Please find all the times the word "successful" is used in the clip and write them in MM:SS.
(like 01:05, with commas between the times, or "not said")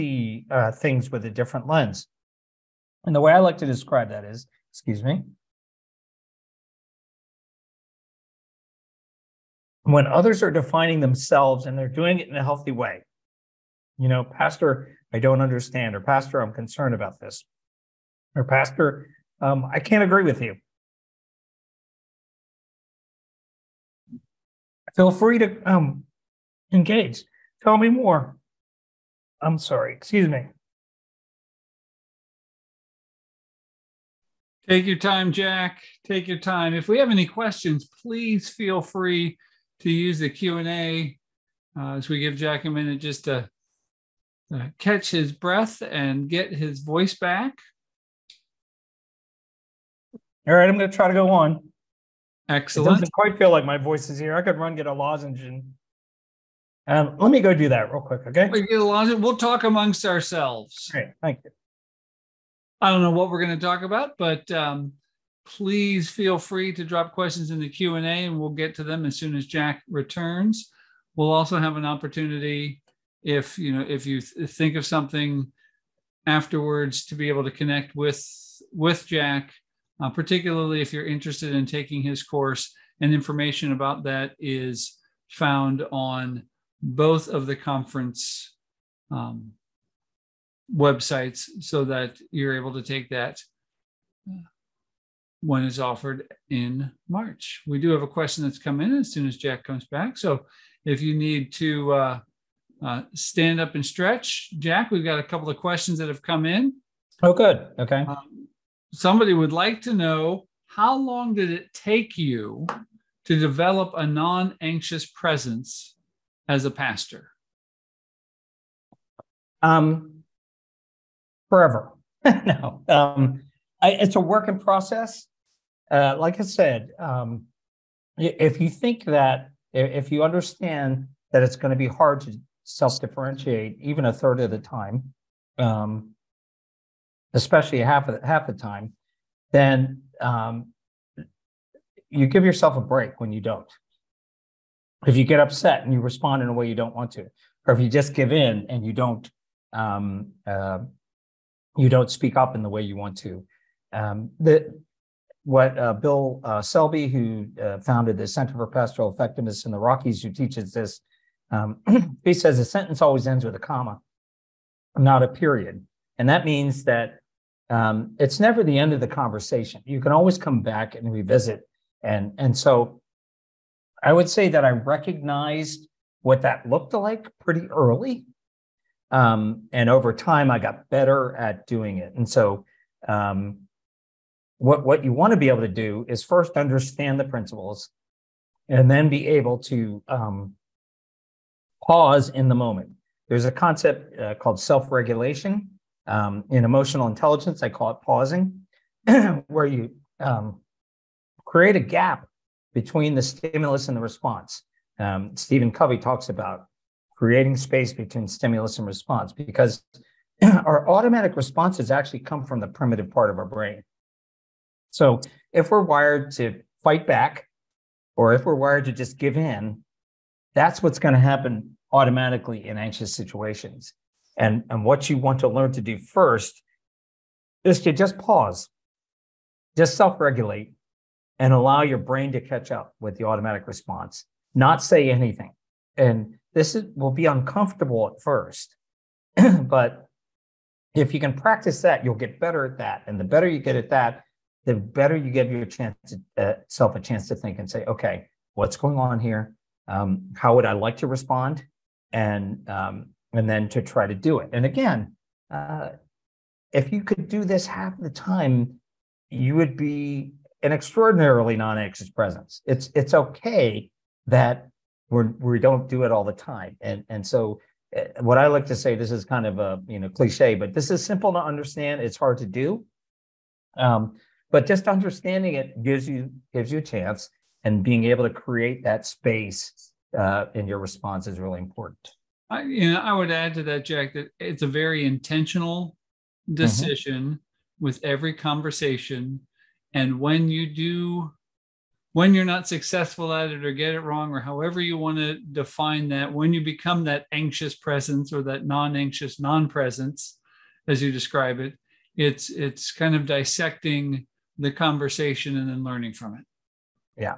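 04:52.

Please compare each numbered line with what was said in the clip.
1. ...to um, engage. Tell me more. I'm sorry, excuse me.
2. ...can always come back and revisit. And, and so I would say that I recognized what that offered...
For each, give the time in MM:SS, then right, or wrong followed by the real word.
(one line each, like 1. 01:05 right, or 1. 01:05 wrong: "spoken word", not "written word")
1. 00:25 right
2. 02:50 wrong: "looked", not "offered".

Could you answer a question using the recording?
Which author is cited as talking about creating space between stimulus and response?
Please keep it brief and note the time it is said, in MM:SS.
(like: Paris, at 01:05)
Stephen Covey, at 03:25.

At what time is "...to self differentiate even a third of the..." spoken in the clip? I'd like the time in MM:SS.
02:12.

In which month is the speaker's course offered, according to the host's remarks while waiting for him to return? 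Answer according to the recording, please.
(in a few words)
March.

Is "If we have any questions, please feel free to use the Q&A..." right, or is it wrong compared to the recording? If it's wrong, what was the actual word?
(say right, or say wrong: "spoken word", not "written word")
right.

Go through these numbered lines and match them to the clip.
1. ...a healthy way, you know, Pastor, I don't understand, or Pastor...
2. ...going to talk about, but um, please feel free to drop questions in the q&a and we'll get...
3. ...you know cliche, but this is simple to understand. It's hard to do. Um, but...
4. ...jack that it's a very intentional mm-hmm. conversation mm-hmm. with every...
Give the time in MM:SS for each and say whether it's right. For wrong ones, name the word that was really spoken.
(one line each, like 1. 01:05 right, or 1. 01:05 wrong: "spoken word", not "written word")
1. 00:12 right
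2. 01:03 right
3. 04:29 right
4. 04:43 wrong: "decision", not "conversation".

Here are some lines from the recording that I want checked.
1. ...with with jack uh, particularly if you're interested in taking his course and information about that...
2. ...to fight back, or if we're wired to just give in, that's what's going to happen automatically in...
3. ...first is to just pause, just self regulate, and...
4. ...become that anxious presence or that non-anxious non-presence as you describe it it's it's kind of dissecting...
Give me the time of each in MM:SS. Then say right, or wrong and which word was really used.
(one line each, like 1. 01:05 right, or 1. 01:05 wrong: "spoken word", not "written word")
1. 01:17 right
2. 03:36 right
3. 03:45 right
4. 04:56 right.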